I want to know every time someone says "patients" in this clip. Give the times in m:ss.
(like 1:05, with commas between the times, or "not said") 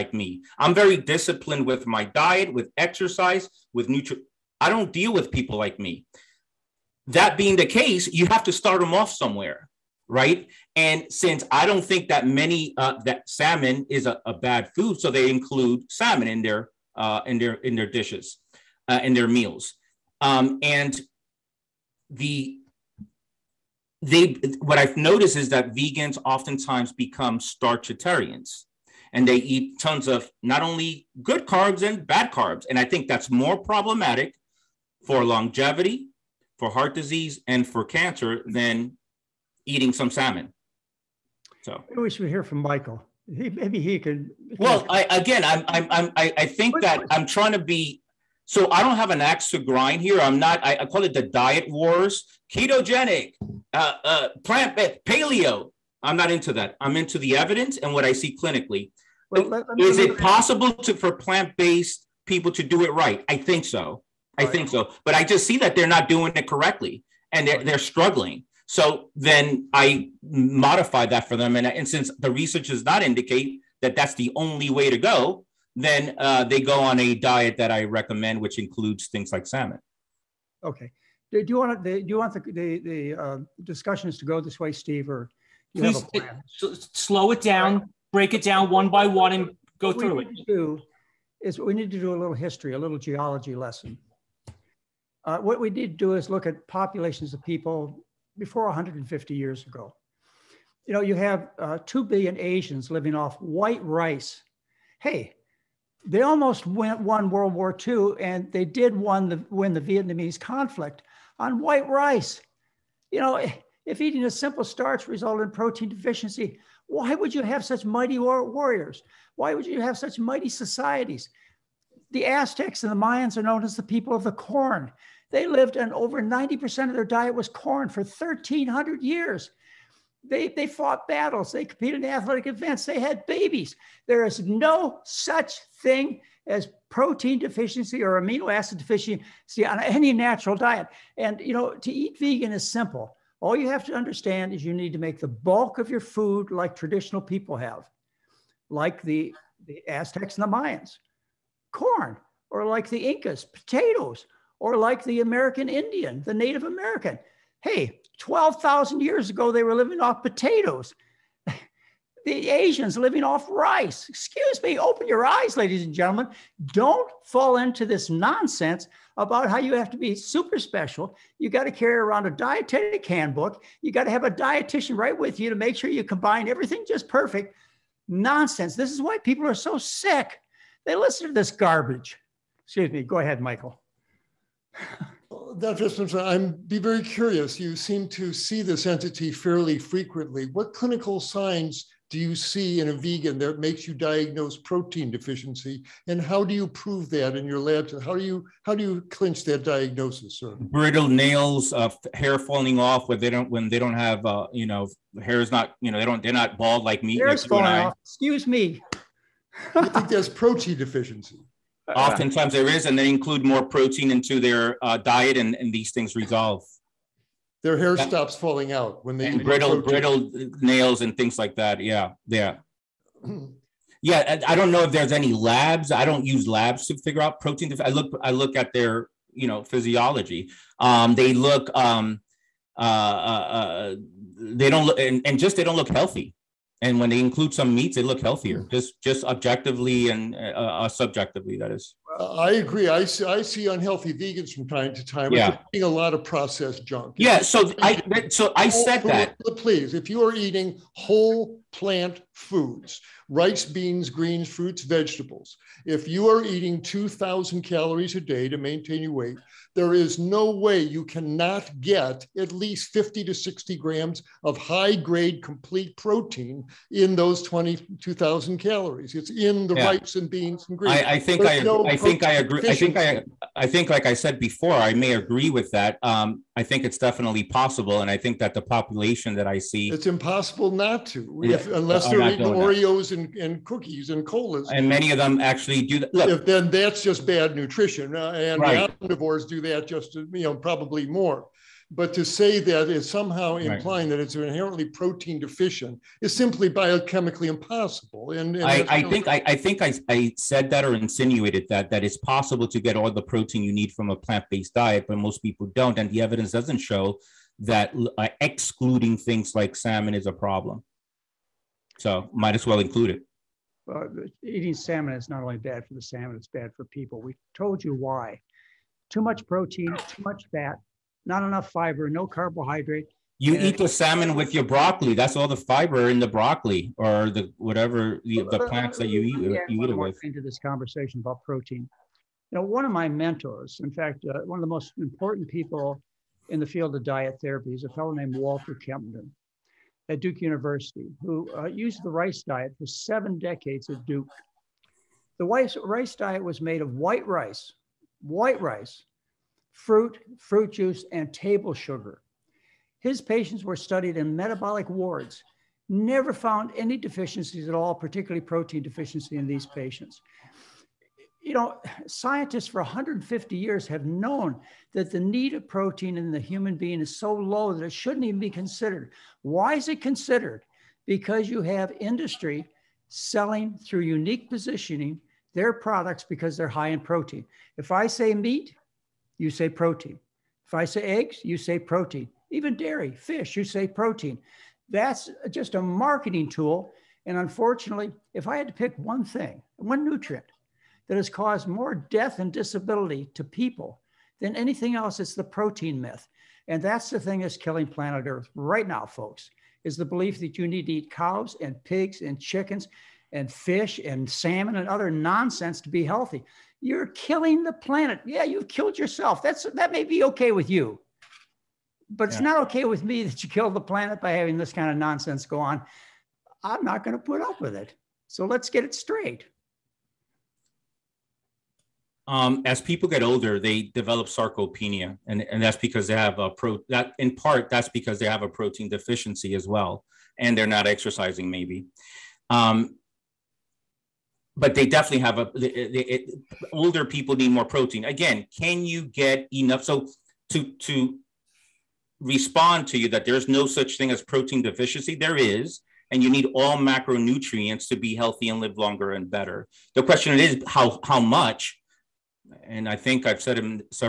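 5:53, 5:59.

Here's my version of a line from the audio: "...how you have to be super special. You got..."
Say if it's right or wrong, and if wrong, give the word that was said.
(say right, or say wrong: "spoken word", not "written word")
right.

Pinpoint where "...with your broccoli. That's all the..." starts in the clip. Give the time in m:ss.
5:24.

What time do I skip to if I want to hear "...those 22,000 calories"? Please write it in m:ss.
4:27.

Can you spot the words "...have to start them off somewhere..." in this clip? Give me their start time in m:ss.
0:08.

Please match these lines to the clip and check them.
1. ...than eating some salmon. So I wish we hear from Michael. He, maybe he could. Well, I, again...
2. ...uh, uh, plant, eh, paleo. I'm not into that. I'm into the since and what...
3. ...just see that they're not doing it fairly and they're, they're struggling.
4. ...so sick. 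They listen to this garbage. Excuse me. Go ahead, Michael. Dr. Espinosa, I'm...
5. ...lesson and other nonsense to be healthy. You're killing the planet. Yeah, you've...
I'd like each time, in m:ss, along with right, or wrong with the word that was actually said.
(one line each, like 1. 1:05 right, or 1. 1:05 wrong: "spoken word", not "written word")
1. 0:38 right
2. 0:53 wrong: "evidence", not "since"
3. 1:05 wrong: "correctly", not "fairly"
4. 2:59 right
5. 6:44 wrong: "salmon", not "lesson".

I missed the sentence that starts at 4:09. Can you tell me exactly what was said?
Please, if you are eating whole plant foods, rice, beans, greens, fruits, vegetables.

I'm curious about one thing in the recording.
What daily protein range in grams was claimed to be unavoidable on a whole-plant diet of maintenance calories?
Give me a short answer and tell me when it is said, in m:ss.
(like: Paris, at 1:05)
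50 to 60 grams, at 4:22.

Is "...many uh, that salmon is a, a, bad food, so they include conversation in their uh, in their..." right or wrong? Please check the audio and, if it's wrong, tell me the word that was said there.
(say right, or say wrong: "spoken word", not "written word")
wrong: "salmon", not "conversation".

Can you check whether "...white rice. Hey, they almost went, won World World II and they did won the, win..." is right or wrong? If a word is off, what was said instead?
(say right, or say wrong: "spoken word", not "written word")
wrong: "War", not "World".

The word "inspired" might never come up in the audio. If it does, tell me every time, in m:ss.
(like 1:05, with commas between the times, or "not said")
not said.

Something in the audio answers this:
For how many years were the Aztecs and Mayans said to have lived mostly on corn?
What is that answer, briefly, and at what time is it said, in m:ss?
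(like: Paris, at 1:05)
1,300 years, at 2:08.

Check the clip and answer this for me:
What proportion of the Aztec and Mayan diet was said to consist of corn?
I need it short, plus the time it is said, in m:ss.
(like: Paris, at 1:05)
over 90%, at 2:05.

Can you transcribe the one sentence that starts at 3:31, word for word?
Oftentimes there is, and they include more protein into their uh, diet, and, and these things resolve.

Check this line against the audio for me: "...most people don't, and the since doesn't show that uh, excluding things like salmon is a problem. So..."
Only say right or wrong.
wrong.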